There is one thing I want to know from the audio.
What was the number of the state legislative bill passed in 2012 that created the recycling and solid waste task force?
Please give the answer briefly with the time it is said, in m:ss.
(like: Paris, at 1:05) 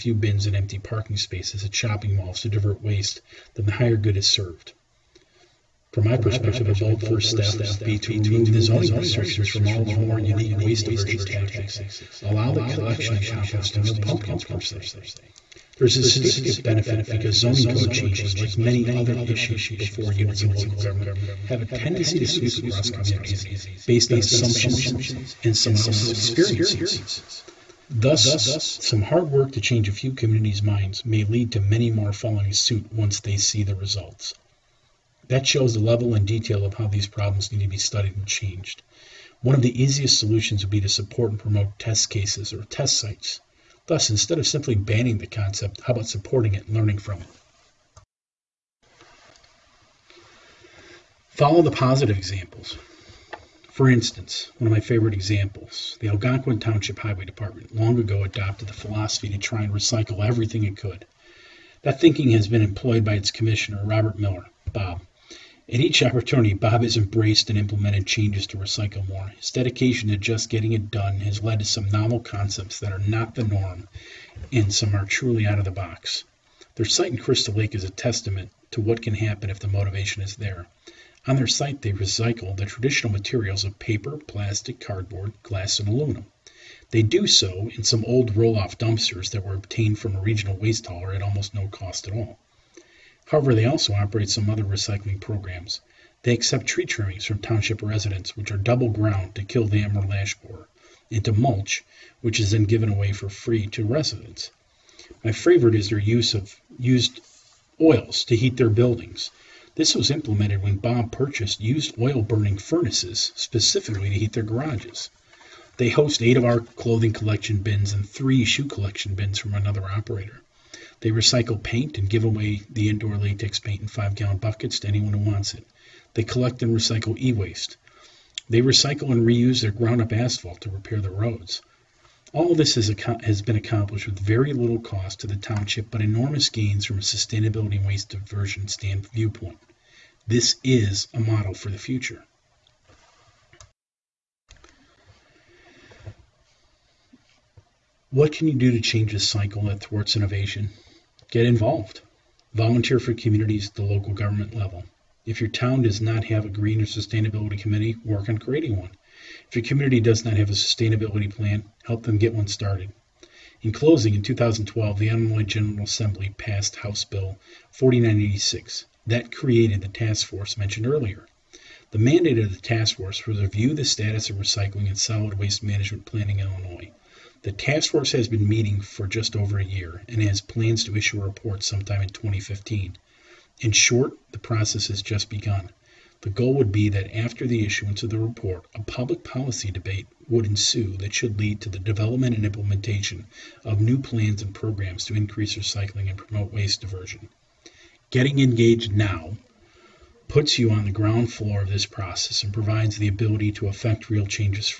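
House Bill 4986, at 2:46.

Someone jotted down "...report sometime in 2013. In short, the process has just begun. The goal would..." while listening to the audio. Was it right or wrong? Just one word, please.
wrong.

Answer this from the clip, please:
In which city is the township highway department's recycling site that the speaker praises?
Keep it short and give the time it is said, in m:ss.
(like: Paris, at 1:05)
Crystal Lake, at 1:17.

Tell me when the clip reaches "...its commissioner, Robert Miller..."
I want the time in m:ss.
1:03.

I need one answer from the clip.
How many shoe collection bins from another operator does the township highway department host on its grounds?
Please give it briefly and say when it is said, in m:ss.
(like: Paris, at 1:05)
3, at 1:58.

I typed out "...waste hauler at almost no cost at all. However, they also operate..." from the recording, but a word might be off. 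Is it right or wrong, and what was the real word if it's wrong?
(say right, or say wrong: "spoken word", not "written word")
right.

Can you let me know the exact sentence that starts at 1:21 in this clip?
On their site, they recycle the traditional materials of paper, plastic, cardboard, glass, and aluminum.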